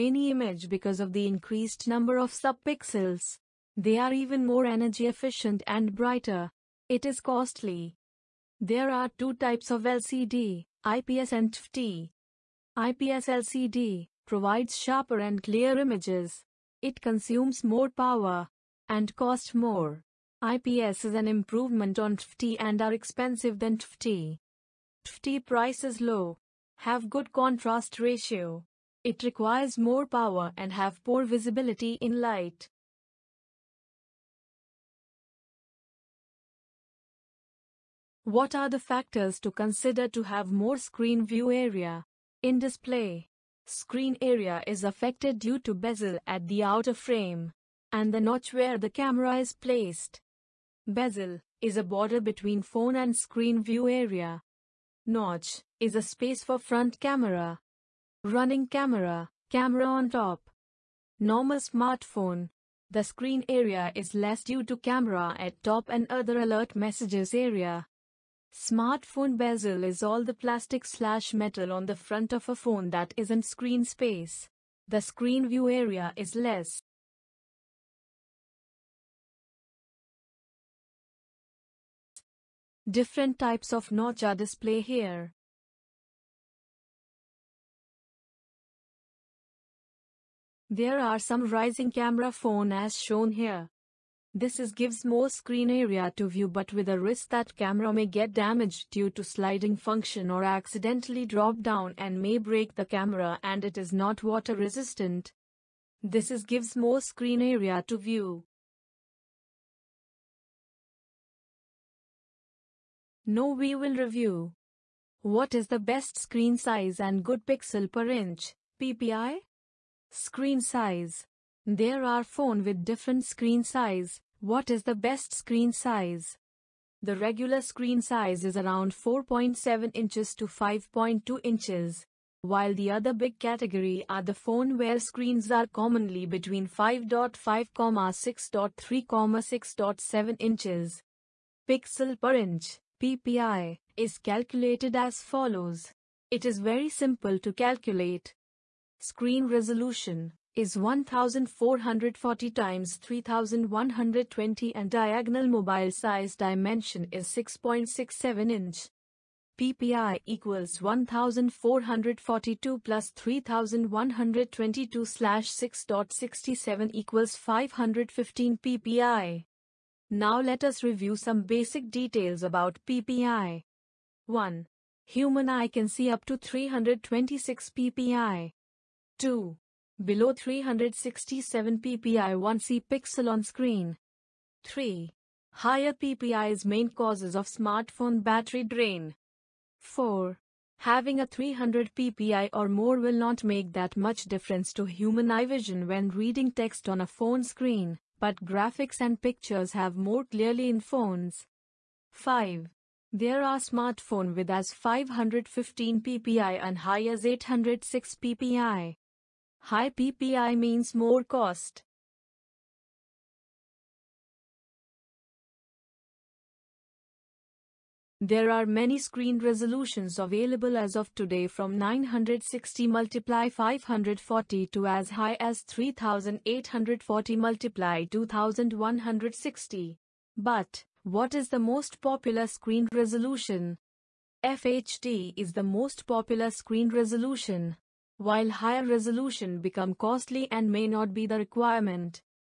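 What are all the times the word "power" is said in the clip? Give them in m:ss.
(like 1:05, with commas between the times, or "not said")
0:17, 0:30.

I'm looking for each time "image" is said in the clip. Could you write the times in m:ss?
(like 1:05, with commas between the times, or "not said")
0:00, 0:15.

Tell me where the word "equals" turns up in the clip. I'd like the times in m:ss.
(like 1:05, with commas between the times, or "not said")
2:40, 2:46.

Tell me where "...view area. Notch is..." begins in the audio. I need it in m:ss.
0:53.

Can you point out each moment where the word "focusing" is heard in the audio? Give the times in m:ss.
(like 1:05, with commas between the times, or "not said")
not said.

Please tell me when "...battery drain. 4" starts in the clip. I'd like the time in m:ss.
3:08.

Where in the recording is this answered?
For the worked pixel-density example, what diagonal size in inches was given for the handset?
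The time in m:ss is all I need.
2:37.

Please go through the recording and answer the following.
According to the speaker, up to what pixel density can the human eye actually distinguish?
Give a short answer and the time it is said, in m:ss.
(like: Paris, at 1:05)
326 PPI, at 2:56.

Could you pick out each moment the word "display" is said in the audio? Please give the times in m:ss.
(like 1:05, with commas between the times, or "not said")
0:42, 1:24.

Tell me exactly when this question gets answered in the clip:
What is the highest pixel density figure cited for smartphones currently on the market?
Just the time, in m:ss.
3:27.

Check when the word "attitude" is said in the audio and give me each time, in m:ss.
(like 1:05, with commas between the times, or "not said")
not said.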